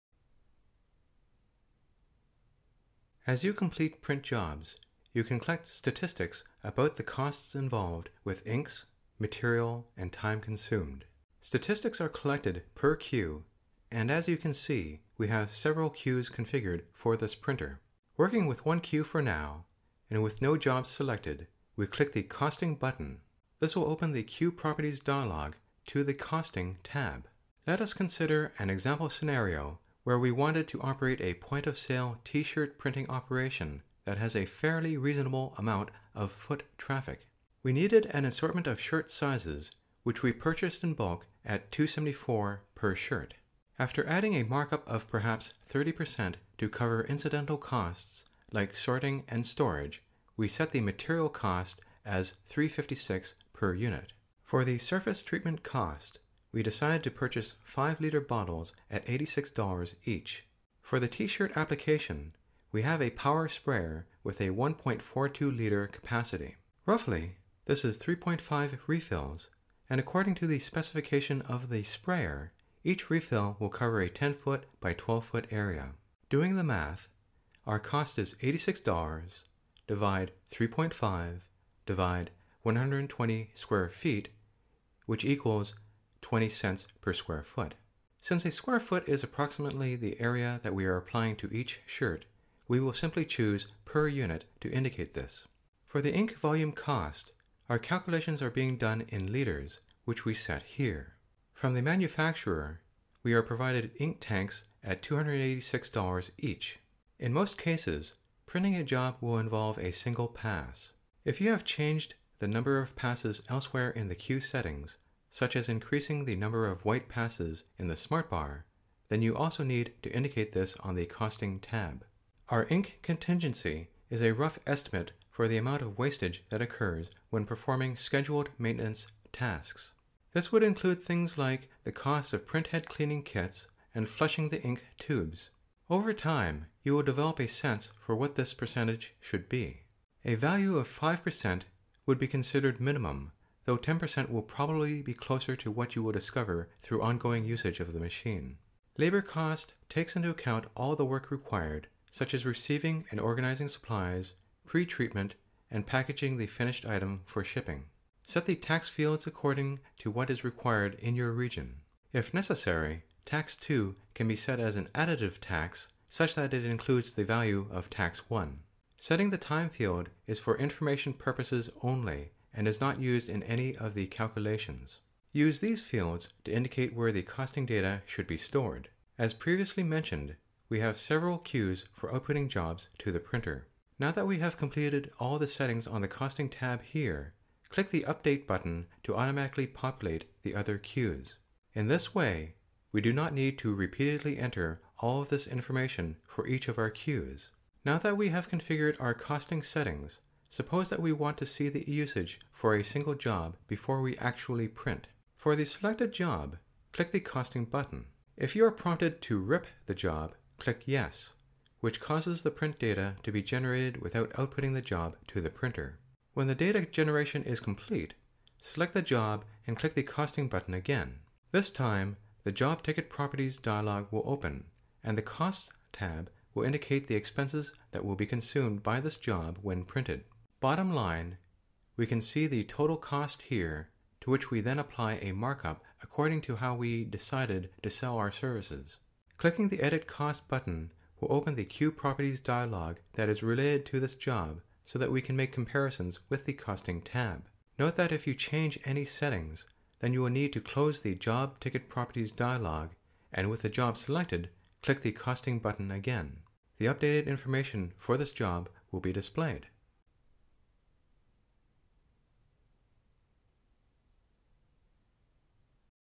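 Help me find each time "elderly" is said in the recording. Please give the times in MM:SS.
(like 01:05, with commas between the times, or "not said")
not said.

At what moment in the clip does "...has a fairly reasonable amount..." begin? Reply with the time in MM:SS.
00:34.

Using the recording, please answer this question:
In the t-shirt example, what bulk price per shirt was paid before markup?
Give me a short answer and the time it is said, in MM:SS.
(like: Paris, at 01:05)
274, at 00:41.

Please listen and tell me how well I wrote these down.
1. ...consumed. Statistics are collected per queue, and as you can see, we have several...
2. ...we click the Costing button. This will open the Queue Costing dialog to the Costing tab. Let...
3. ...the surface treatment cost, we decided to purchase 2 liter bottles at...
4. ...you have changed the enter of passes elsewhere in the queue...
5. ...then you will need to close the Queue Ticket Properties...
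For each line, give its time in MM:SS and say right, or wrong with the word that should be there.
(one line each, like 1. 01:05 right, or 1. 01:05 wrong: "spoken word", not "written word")
1. 00:10 right
2. 00:21 wrong: "Properties", not "Costing"
3. 00:54 wrong: "5", not "2"
4. 01:51 wrong: "number", not "enter"
5. 04:09 wrong: "Job", not "Queue".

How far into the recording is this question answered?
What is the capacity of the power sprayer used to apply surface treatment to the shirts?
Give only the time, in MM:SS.
01:04.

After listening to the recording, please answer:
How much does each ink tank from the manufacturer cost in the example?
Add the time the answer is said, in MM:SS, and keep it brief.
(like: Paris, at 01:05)
$286, at 01:45.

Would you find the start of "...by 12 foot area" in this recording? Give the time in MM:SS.
01:14.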